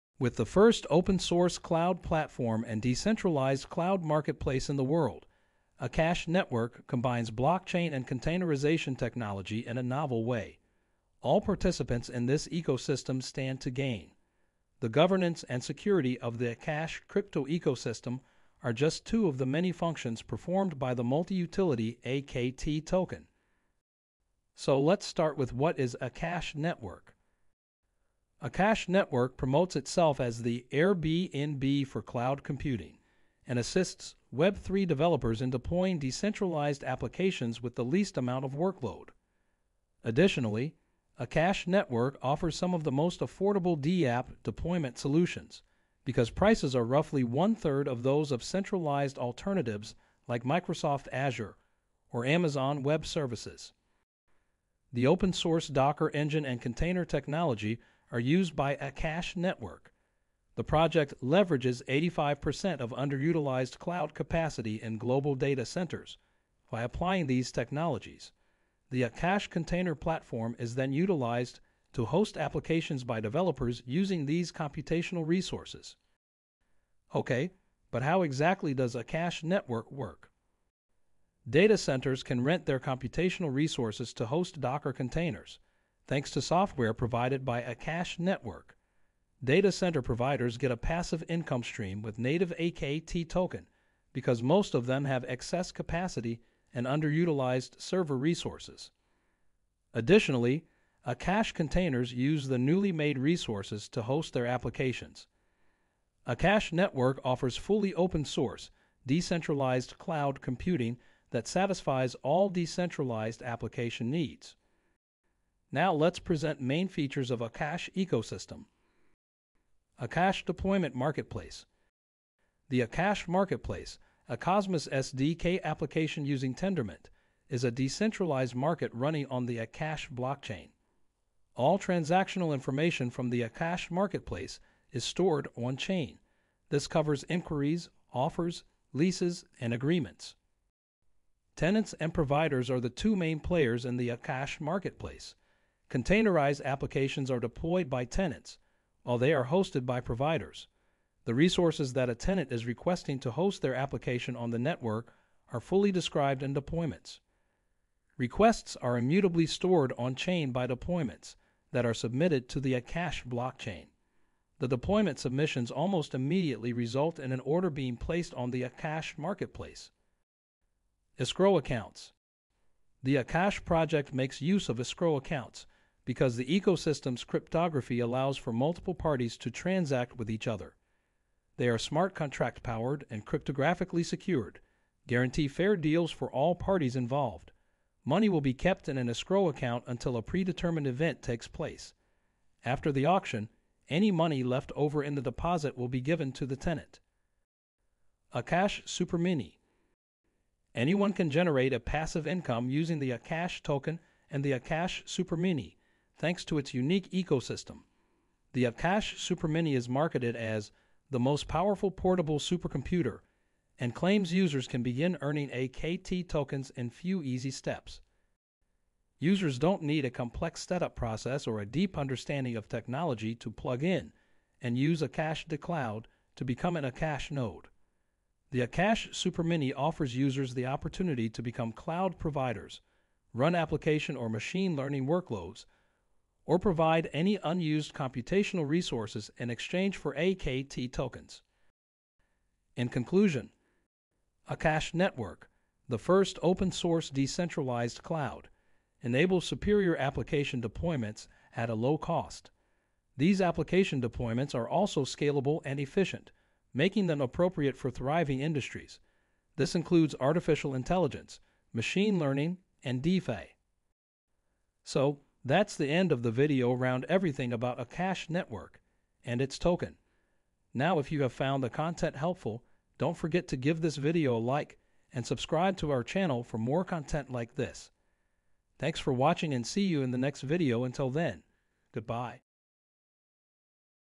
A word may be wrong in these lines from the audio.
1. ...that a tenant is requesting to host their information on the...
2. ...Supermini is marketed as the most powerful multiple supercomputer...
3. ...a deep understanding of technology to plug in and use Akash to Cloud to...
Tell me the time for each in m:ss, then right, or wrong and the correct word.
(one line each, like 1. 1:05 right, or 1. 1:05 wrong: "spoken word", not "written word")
1. 2:31 wrong: "application", not "information"
2. 3:29 wrong: "portable", not "multiple"
3. 3:41 right.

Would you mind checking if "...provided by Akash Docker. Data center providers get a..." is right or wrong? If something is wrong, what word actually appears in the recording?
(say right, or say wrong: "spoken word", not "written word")
wrong: "Network", not "Docker".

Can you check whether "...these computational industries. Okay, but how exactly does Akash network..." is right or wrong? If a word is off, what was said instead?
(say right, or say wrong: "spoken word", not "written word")
wrong: "resources", not "industries".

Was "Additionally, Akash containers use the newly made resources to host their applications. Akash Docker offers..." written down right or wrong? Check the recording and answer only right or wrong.
wrong.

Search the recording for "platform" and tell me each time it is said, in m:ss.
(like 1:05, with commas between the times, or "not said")
0:02, 1:09.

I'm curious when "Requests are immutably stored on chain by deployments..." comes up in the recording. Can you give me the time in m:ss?
2:38.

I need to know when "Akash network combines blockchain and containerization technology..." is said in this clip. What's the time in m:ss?
0:05.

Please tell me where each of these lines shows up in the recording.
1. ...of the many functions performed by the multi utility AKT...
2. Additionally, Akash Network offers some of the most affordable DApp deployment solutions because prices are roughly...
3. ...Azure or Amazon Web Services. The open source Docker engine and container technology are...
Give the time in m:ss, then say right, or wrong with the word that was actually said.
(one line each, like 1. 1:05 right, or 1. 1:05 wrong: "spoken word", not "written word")
1. 0:19 right
2. 0:40 right
3. 0:51 right.